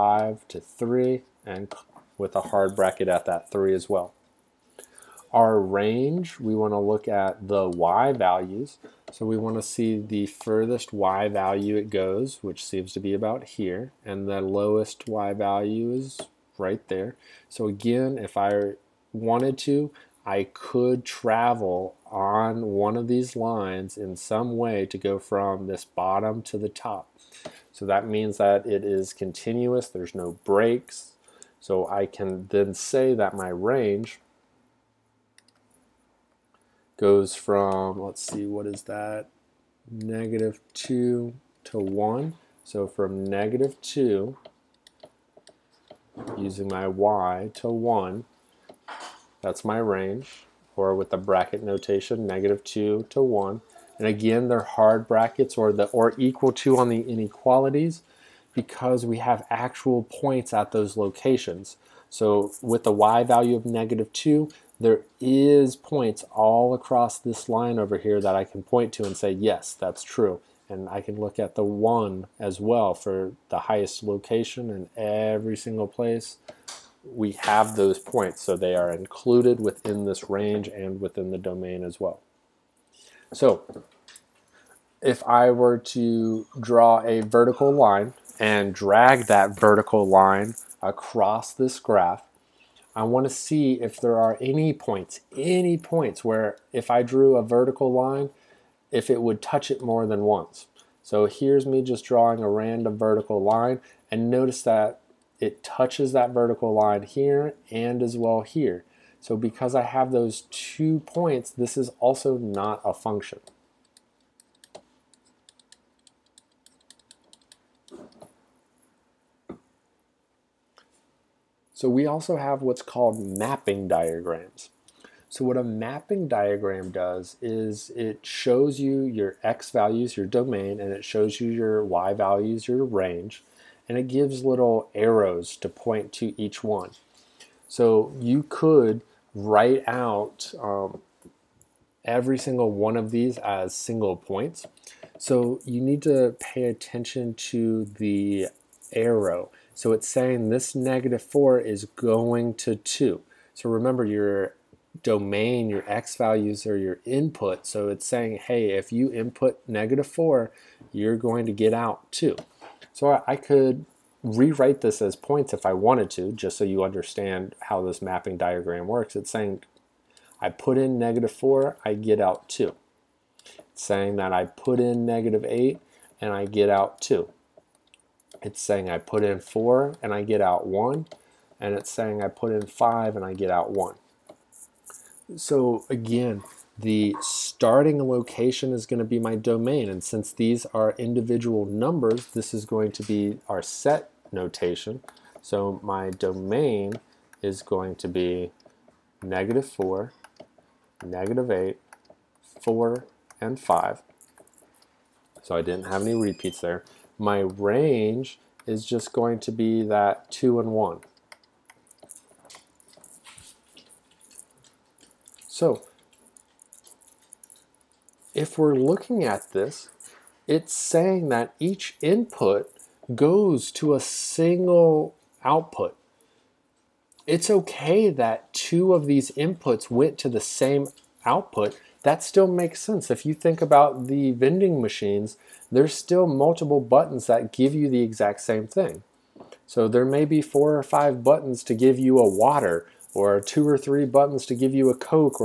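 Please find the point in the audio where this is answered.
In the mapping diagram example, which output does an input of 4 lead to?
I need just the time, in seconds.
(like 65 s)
178 s.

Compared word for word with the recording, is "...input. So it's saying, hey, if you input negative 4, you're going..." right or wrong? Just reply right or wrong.
right.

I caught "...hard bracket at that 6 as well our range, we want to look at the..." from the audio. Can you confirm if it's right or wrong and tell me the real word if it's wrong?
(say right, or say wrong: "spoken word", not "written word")
wrong: "3", not "6".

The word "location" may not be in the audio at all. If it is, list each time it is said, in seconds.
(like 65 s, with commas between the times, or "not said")
60 s, 74 s, 188 s.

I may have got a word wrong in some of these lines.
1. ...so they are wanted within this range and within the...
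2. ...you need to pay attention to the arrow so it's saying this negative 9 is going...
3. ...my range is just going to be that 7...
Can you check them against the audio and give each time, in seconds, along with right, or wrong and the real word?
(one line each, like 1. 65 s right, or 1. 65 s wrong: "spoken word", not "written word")
1. 78 s wrong: "included", not "wanted"
2. 145 s wrong: "4", not "9"
3. 207 s wrong: "2", not "7".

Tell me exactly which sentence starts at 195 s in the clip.
So my domain is going to be negative 4, negative 8, 4, and 5.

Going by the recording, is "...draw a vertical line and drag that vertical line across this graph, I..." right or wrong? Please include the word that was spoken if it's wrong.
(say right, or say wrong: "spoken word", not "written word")
right.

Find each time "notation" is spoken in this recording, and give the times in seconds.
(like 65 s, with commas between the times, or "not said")
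51 s, 194 s.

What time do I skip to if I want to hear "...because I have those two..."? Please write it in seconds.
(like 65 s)
109 s.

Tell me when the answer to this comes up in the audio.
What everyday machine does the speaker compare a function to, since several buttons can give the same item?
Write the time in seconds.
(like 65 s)
234 s.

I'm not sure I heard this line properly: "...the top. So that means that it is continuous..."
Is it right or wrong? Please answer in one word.
right.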